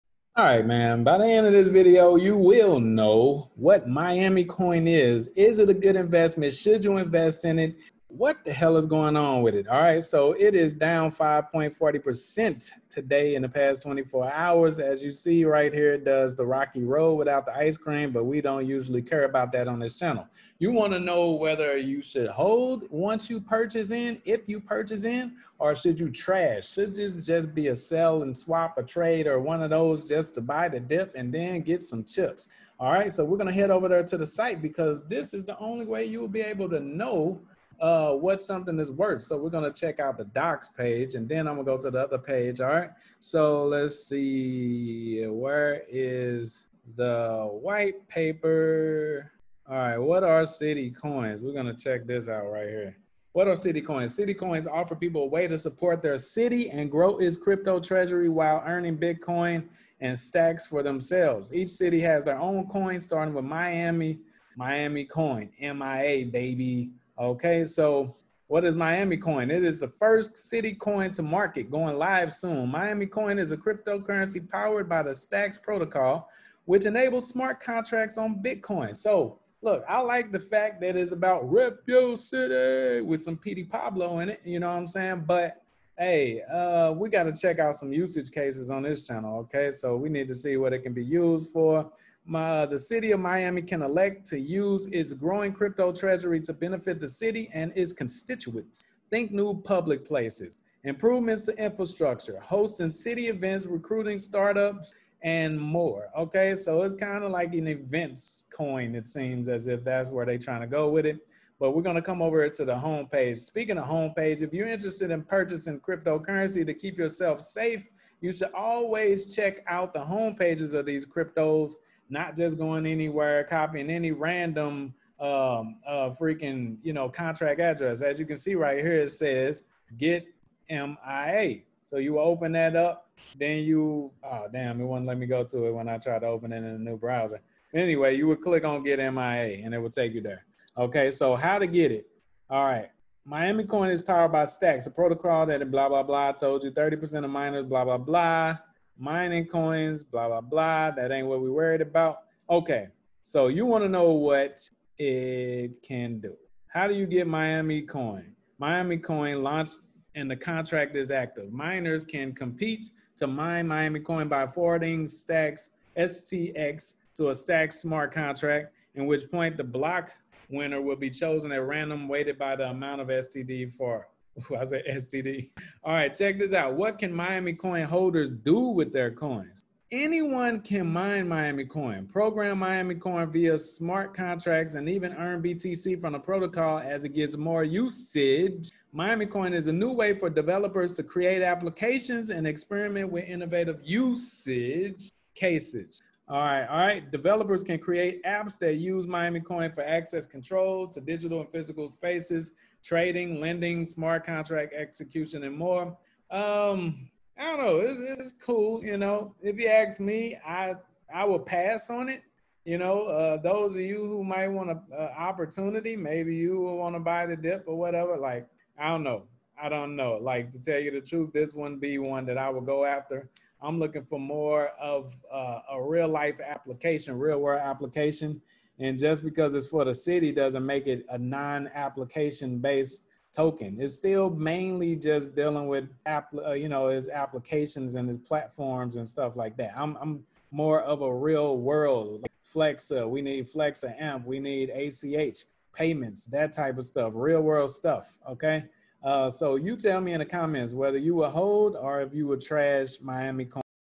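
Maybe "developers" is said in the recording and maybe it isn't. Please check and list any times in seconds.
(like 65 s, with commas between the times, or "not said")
190 s, 197 s.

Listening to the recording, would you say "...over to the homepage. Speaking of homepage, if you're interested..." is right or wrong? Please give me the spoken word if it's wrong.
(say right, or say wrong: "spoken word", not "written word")
right.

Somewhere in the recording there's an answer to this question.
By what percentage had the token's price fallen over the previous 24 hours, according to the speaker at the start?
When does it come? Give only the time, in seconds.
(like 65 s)
11 s.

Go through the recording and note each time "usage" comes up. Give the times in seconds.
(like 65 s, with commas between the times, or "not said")
87 s, 187 s, 193 s.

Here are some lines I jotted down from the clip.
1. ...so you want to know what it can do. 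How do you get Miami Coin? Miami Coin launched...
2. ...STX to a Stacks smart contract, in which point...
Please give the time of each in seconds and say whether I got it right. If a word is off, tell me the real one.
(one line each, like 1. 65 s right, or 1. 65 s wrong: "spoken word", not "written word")
1. 153 s right
2. 165 s right.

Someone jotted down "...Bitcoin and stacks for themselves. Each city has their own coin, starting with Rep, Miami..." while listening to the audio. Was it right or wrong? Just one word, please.
wrong.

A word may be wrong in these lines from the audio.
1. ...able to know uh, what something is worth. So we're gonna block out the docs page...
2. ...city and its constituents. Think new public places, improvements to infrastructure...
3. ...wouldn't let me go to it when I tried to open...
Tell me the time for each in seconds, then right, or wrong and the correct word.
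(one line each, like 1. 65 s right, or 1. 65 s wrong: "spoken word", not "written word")
1. 36 s wrong: "check", not "block"
2. 97 s right
3. 134 s right.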